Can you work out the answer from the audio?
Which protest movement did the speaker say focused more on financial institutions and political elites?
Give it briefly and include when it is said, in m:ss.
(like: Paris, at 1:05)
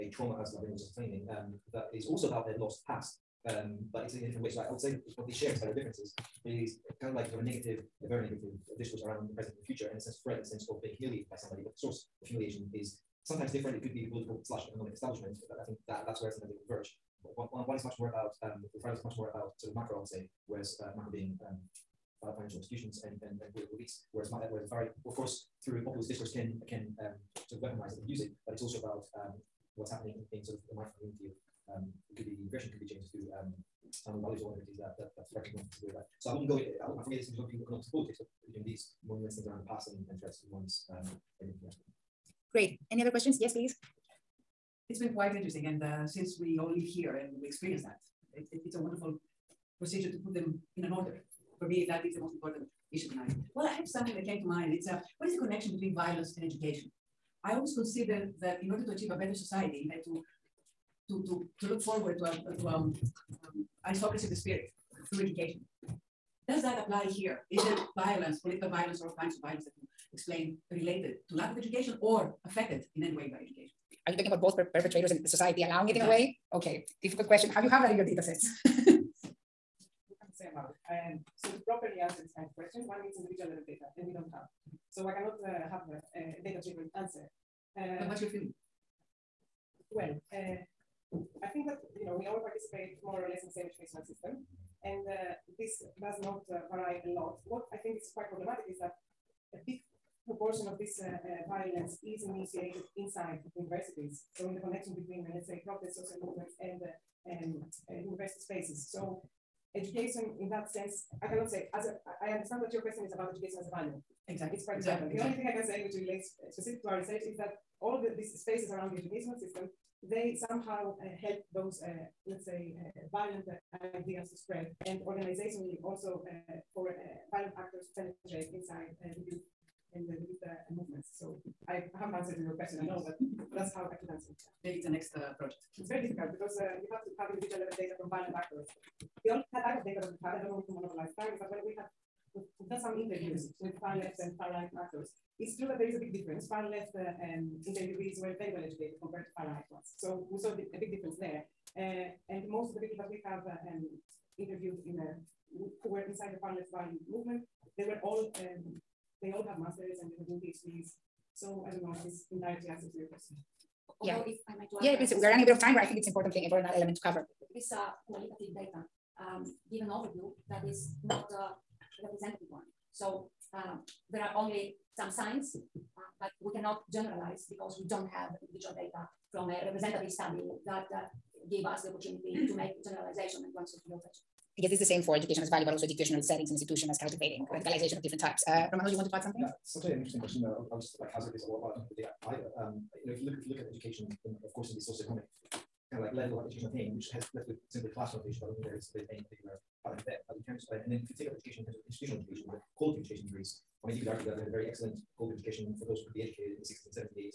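The Fridays, at 0:18.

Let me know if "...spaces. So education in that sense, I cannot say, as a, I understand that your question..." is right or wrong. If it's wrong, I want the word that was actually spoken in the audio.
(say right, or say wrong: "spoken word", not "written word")
right.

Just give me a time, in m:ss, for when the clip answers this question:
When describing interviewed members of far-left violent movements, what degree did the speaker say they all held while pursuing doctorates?
2:39.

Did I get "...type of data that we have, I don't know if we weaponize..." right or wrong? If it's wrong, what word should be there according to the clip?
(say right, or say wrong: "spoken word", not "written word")
wrong: "monopolize", not "weaponize".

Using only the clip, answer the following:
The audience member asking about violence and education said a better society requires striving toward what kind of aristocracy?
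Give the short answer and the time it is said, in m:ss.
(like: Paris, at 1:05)
Aristocracy of the spirit, at 1:03.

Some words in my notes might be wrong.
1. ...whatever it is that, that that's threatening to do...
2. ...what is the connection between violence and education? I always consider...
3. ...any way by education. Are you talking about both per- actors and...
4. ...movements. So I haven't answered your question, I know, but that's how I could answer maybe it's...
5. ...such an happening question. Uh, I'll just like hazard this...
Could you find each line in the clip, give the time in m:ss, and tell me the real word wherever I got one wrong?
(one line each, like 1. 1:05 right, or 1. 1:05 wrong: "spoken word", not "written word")
1. 0:34 right
2. 0:55 right
3. 1:13 wrong: "perpetrators", not "actors"
4. 2:10 right
5. 3:09 wrong: "interesting", not "happening".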